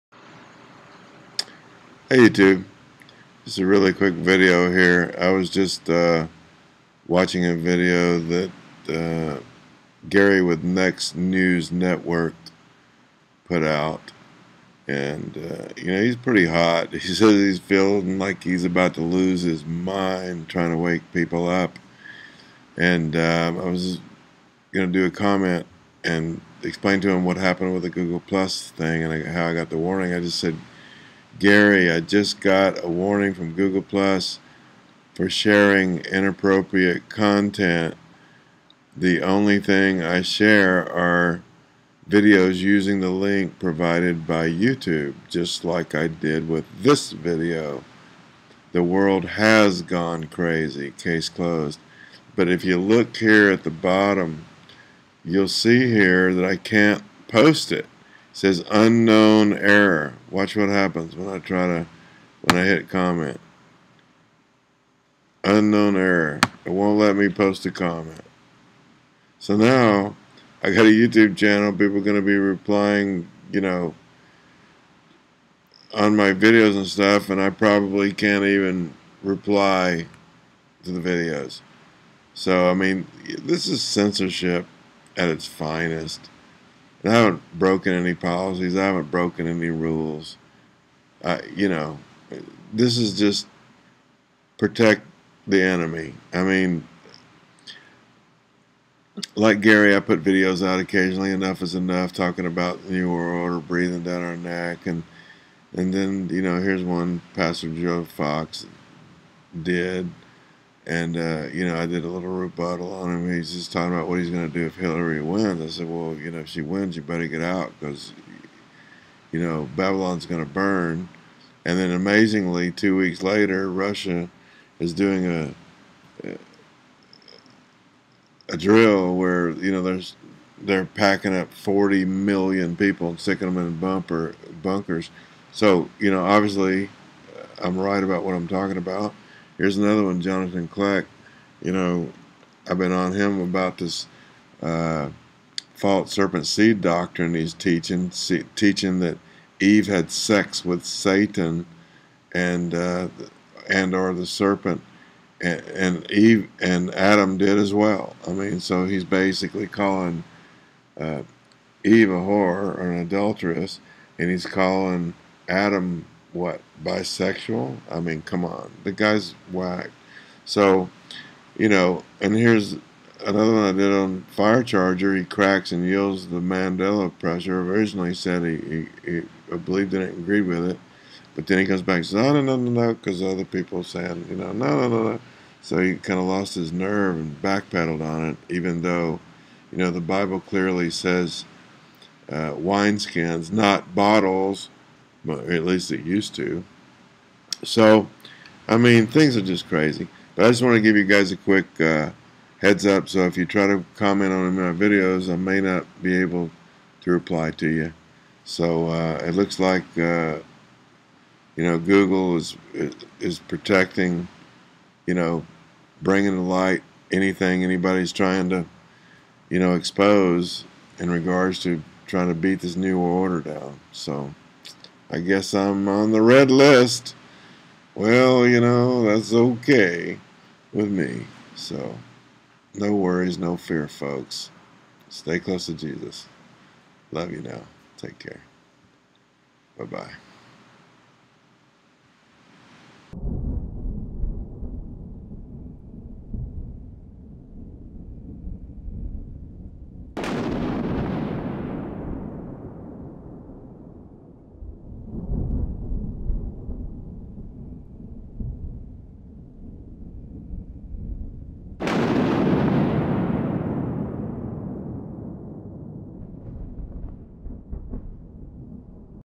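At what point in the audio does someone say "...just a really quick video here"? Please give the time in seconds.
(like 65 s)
3 s.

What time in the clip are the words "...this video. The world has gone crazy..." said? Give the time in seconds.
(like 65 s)
46 s.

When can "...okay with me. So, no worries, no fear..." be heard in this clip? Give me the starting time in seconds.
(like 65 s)
229 s.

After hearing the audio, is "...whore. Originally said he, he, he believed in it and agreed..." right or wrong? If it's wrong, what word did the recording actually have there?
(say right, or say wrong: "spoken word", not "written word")
wrong: "pressure", not "whore".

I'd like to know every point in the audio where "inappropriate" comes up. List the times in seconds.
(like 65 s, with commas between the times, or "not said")
36 s.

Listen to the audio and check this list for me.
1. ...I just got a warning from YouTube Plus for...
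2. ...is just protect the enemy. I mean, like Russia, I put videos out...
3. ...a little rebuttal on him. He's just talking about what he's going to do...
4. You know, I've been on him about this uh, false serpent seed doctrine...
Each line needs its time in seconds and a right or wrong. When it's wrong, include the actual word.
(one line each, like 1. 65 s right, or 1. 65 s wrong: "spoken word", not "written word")
1. 31 s wrong: "Google", not "YouTube"
2. 92 s wrong: "Gary", not "Russia"
3. 112 s right
4. 141 s right.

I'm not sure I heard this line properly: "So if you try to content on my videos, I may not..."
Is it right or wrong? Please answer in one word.
wrong.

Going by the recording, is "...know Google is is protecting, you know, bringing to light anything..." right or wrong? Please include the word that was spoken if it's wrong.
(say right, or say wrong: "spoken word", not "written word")
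right.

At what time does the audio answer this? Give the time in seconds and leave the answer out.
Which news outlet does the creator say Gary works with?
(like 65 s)
10 s.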